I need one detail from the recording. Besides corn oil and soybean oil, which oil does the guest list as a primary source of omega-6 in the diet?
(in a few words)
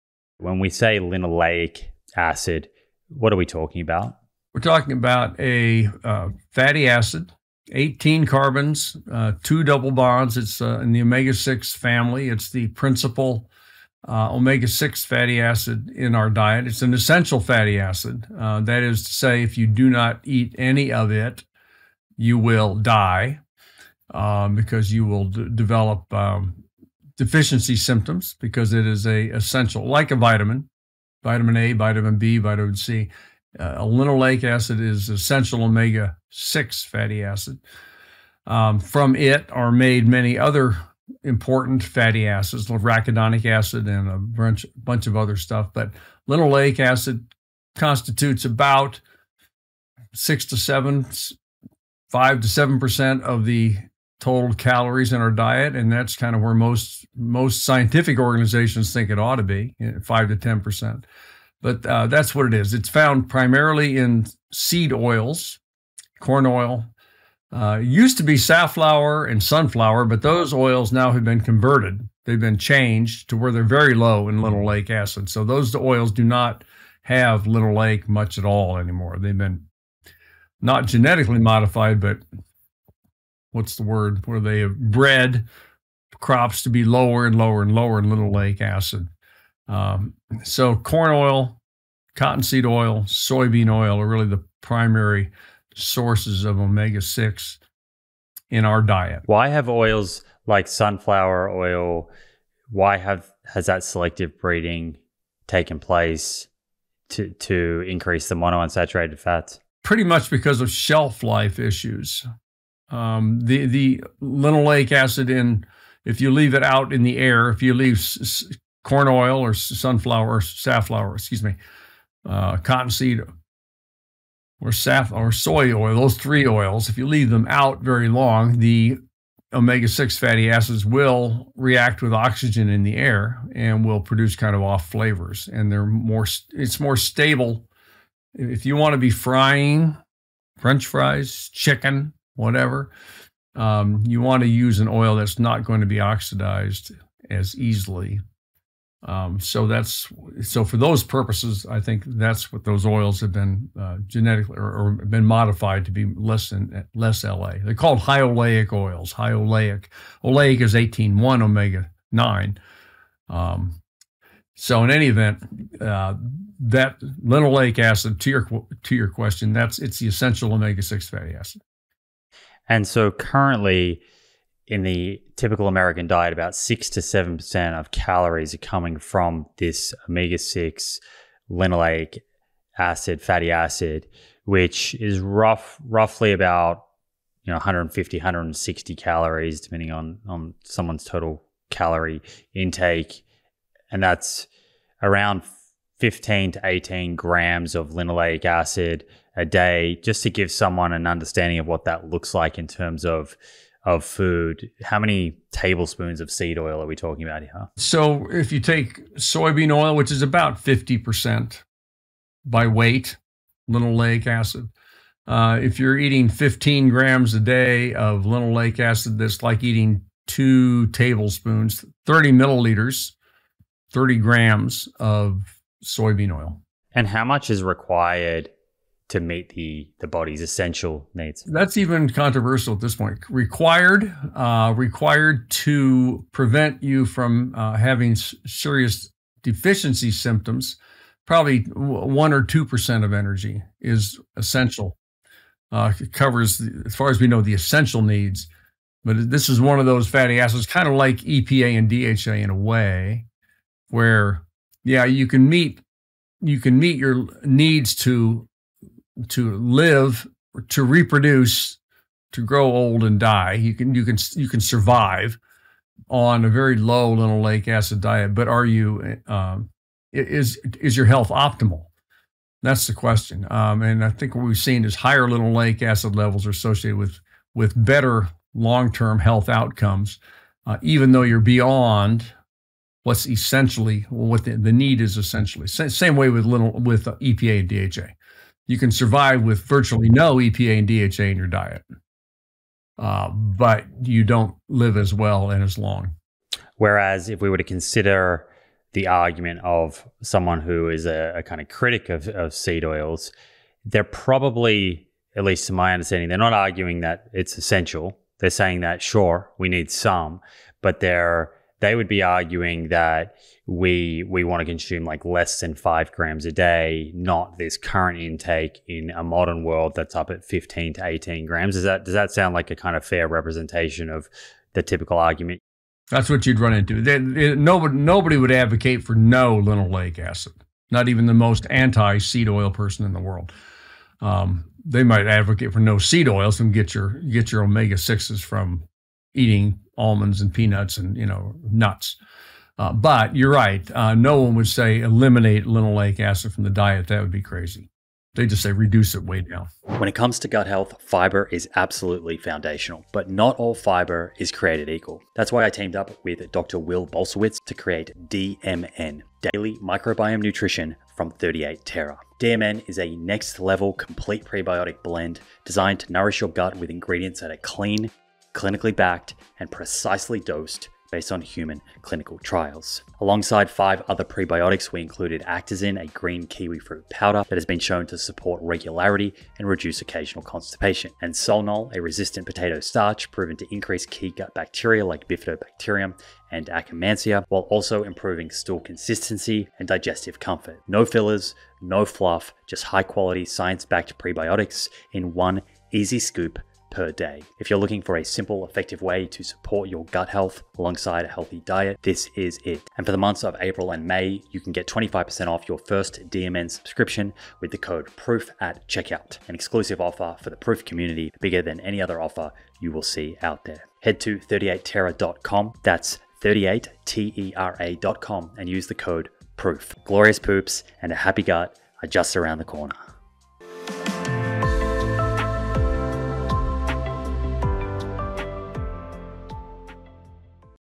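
cottonseed oil.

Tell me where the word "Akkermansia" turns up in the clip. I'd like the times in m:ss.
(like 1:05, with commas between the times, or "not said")
6:26.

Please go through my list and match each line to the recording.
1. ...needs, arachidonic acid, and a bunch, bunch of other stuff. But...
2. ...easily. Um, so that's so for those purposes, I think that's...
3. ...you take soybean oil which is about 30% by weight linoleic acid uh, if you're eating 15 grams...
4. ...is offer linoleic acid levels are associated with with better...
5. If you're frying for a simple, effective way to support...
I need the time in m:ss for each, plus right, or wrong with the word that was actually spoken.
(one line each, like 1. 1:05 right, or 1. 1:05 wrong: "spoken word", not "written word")
1. 0:42 wrong: "acids", not "needs"
2. 2:27 right
3. 3:28 wrong: "50", not "30"
4. 4:34 wrong: "higher", not "offer"
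5. 6:37 wrong: "looking", not "frying".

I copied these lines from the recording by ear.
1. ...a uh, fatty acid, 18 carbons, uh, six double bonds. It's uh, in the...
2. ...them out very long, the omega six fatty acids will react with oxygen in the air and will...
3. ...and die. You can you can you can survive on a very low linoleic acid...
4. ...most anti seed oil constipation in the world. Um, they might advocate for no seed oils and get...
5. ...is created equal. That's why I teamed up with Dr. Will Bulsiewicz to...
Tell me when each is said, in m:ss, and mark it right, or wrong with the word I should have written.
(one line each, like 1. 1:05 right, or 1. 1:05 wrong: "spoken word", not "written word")
1. 0:05 wrong: "two", not "six"
2. 2:07 right
3. 4:23 right
4. 5:31 wrong: "person", not "constipation"
5. 5:54 right.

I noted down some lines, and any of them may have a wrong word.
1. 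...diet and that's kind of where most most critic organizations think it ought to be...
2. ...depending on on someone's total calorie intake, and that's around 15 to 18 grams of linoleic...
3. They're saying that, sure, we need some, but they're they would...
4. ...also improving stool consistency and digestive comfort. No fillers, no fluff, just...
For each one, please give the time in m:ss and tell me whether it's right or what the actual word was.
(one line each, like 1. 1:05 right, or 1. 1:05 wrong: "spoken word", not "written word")
1. 0:55 wrong: "scientific", not "critic"
2. 3:09 right
3. 5:08 right
4. 6:27 right.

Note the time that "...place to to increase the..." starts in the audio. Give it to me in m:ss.
1:45.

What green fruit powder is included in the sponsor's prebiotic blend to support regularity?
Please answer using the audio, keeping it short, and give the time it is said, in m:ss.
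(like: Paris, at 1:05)
Actazin, at 6:15.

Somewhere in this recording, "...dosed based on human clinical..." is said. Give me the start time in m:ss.
6:10.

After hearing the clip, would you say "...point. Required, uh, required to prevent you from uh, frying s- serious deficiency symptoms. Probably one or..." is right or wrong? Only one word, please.
wrong.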